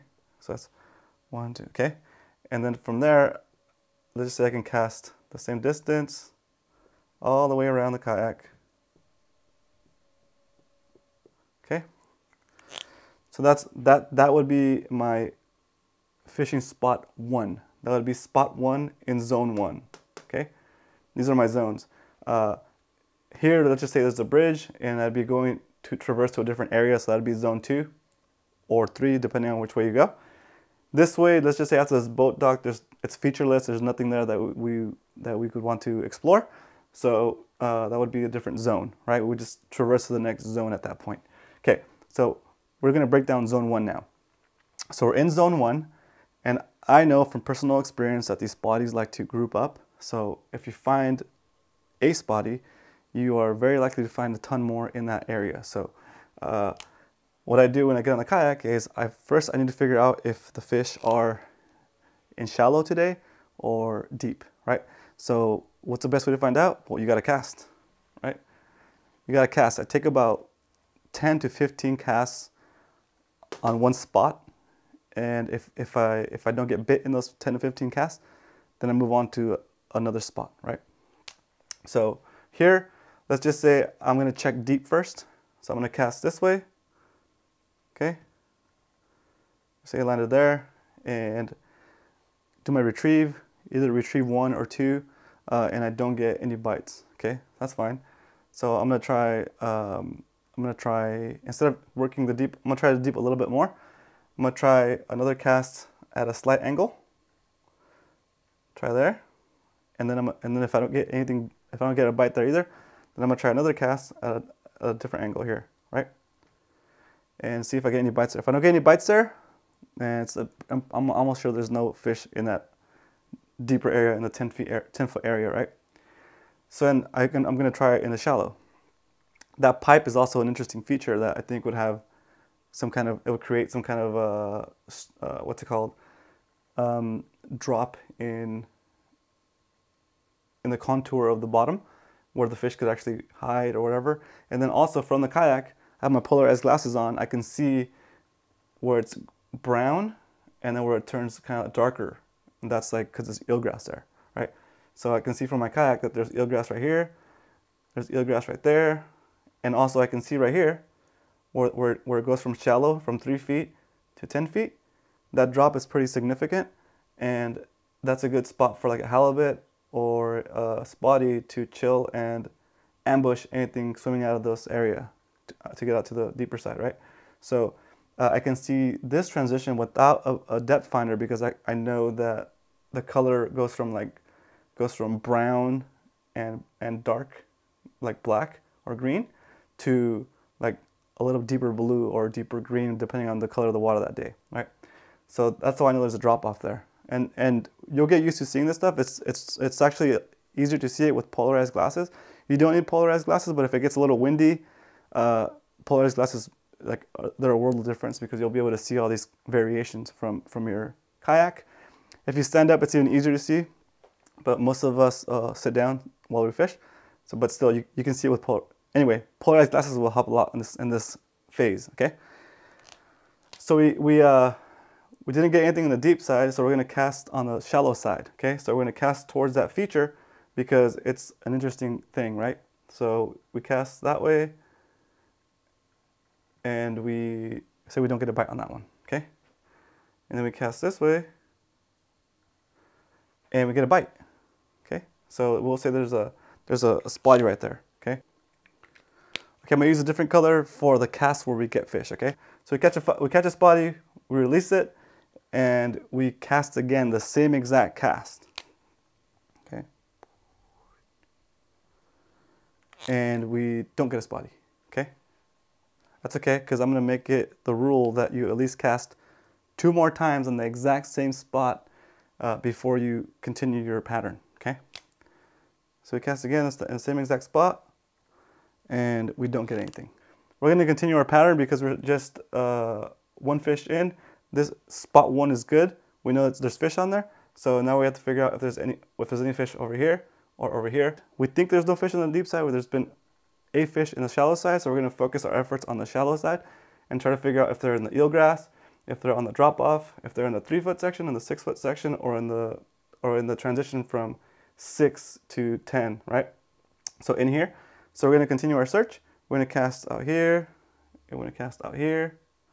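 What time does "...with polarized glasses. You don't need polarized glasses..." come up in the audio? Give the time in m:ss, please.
3:21.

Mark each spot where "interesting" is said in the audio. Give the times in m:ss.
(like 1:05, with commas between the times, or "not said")
2:10, 3:51.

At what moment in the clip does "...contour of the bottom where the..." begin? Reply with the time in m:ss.
2:20.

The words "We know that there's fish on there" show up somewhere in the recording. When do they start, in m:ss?
4:46.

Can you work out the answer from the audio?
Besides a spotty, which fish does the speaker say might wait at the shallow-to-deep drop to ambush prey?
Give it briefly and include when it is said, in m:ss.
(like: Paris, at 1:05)
Halibut, at 2:49.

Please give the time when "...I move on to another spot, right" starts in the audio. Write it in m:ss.
1:18.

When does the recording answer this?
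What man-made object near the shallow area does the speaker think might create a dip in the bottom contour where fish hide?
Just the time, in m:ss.
2:09.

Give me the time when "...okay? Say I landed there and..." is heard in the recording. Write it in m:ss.
1:27.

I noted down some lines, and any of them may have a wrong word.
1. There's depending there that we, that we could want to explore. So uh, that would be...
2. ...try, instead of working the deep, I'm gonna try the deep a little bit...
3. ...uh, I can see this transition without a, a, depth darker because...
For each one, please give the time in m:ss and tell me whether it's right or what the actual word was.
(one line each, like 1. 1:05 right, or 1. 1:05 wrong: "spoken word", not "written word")
1. 0:33 wrong: "nothing", not "depending"
2. 1:40 right
3. 2:58 wrong: "finder", not "darker".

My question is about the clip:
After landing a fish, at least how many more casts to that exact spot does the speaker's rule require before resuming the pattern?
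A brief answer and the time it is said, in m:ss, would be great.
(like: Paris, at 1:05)
2, at 4:29.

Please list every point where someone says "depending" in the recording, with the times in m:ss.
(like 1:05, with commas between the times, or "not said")
0:29, 3:12.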